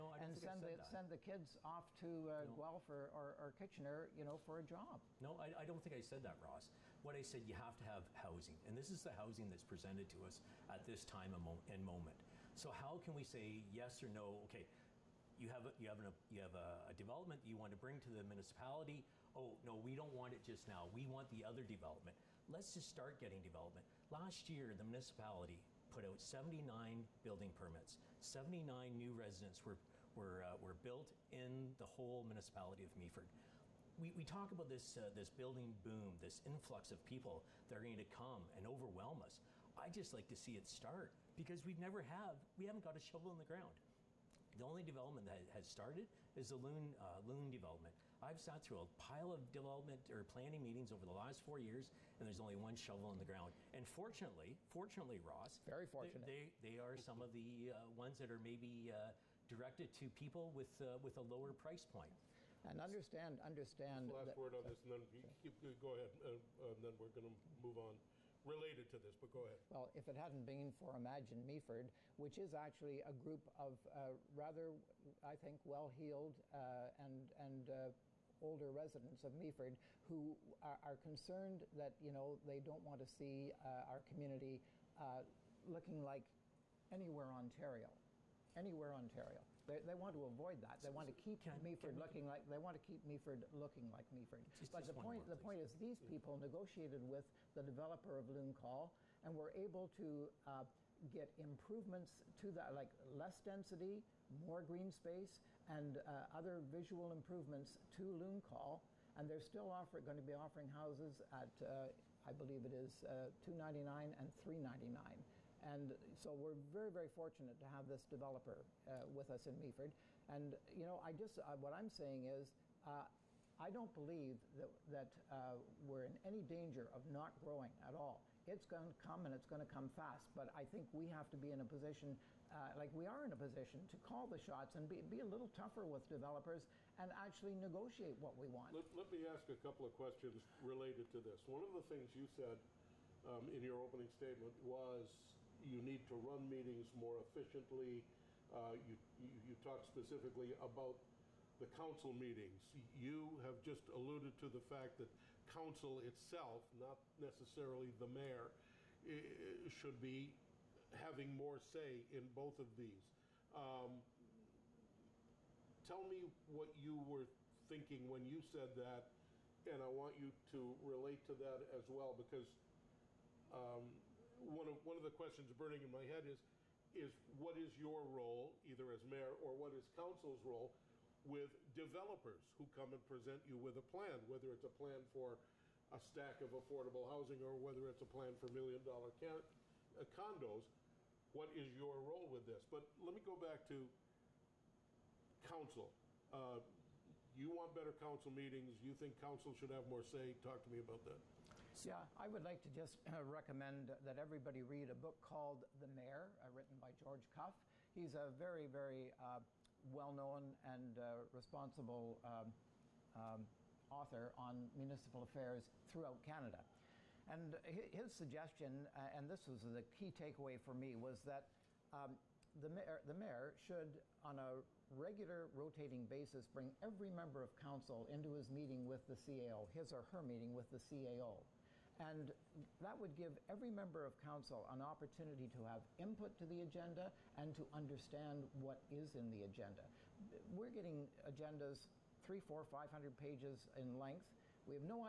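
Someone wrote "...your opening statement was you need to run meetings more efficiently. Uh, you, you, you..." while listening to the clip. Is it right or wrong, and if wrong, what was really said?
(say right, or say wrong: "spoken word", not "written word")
right.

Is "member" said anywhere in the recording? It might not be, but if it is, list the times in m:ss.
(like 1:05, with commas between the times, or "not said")
3:47, 3:53.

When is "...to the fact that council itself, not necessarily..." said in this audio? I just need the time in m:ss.
2:34.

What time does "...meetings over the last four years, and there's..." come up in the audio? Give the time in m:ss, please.
0:50.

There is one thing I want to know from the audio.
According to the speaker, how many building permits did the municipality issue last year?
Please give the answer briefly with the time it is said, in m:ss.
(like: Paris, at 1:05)
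79, at 0:26.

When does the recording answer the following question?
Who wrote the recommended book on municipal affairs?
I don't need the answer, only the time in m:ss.
3:26.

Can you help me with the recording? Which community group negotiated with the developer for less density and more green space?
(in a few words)
Imagine Meaford.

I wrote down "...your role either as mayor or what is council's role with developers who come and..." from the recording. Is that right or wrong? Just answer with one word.
right.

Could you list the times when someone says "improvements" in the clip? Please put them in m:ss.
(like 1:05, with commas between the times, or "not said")
1:41, 1:47.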